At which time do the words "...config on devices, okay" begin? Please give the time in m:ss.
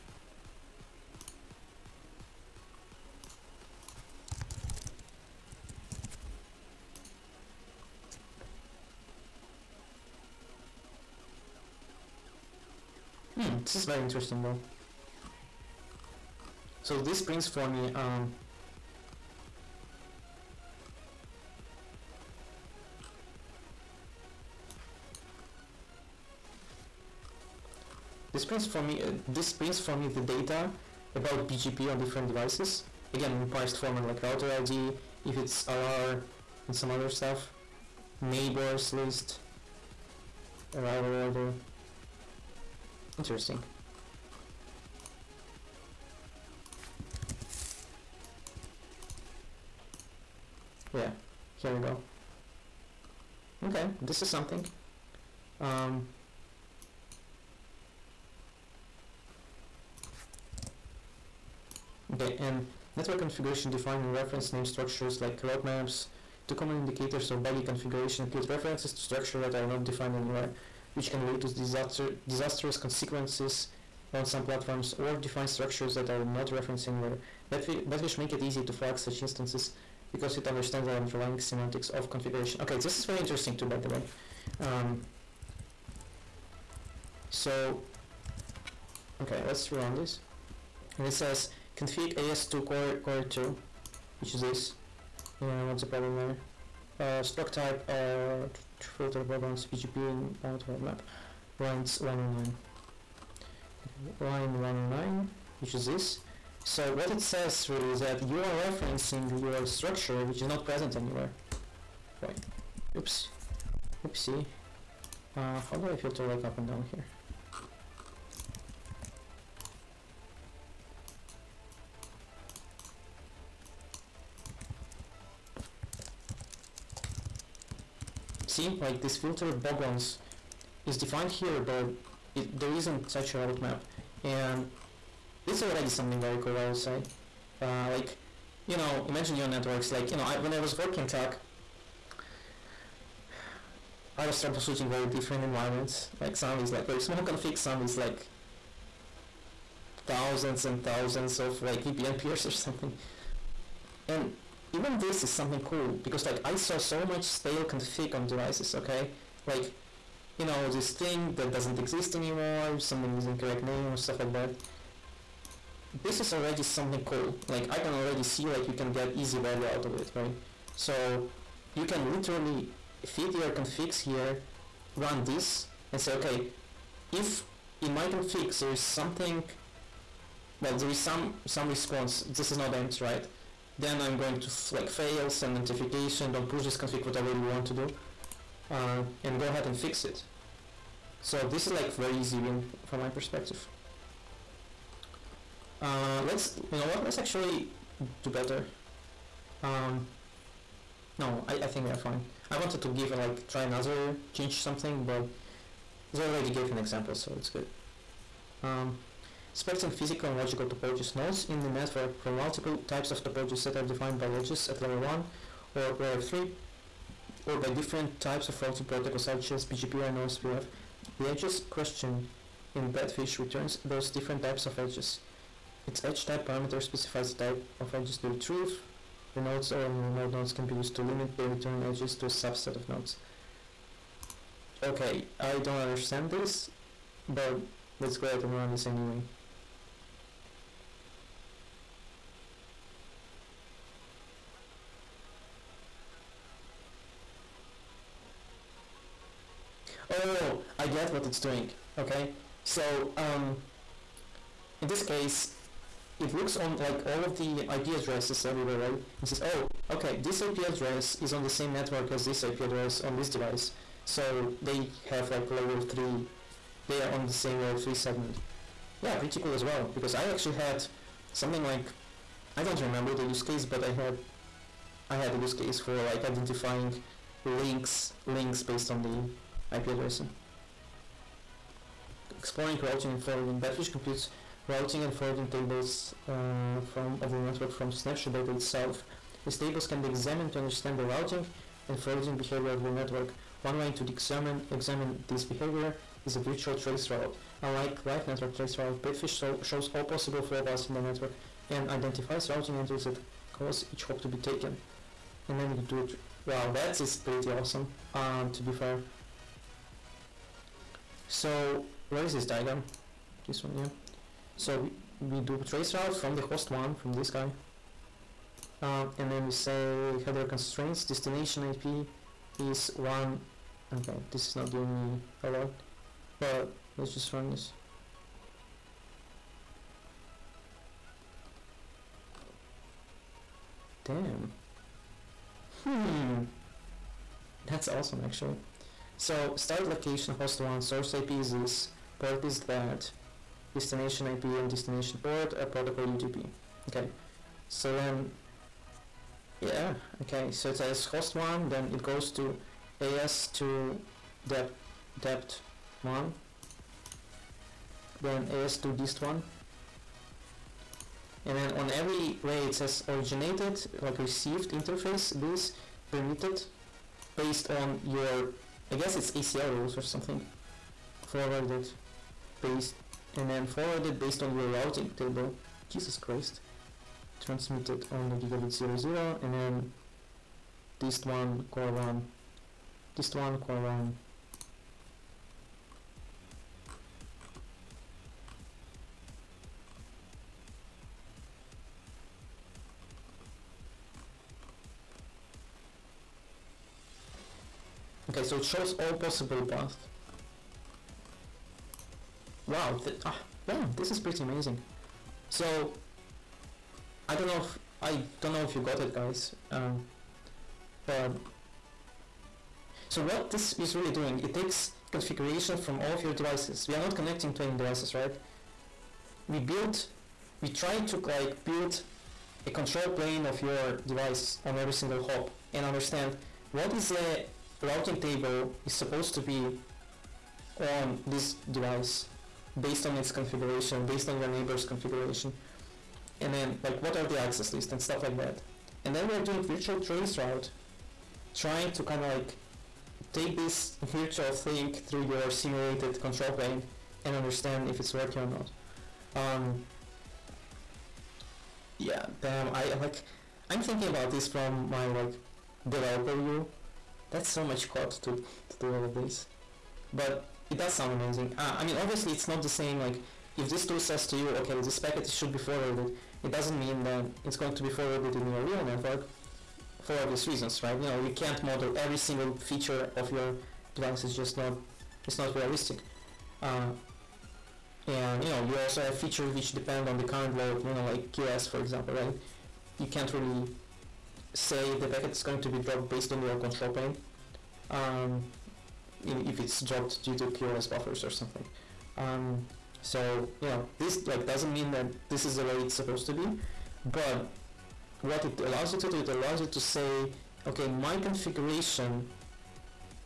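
2:37.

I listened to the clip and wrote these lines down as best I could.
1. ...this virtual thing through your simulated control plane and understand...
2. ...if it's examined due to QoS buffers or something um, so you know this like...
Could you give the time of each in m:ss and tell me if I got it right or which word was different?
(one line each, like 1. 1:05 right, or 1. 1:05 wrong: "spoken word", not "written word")
1. 7:23 right
2. 8:09 wrong: "dropped", not "examined".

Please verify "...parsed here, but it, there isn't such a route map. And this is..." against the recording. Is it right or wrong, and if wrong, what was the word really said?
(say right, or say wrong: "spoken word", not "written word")
wrong: "defined", not "parsed".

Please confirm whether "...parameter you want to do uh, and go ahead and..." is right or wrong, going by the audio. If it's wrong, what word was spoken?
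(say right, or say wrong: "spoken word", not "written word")
wrong: "whatever", not "parameter".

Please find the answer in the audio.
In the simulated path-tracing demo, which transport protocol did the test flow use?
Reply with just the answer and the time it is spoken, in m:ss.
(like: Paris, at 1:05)
UDP, at 5:46.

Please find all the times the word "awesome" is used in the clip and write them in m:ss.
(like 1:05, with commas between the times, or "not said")
5:07, 5:37.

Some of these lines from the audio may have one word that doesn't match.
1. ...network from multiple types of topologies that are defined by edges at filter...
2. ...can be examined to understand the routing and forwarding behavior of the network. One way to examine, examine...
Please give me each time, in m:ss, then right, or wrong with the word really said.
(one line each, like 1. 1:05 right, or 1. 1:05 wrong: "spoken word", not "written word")
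1. 3:31 wrong: "layer", not "filter"
2. 4:49 right.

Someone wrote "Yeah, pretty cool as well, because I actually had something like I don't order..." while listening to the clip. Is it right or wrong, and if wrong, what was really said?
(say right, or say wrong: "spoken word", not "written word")
wrong: "remember", not "order".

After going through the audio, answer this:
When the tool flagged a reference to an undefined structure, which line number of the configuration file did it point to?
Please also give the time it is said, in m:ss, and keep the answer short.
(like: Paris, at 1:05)
109, at 1:44.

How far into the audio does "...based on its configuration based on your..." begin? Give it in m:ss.
7:12.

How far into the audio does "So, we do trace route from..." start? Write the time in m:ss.
5:14.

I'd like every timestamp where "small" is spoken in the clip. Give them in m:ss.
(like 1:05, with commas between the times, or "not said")
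2:26.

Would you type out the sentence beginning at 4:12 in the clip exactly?
So, um, in this case, it looks on like all of the IP addresses everywhere, right?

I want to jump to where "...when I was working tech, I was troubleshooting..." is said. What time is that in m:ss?
2:20.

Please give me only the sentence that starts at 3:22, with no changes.
I wanted to give and like try another change something, but they already gave an example, so it's good.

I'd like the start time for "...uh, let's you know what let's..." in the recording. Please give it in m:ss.
3:15.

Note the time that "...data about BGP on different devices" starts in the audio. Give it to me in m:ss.
0:30.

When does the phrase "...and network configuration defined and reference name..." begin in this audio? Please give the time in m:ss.
1:02.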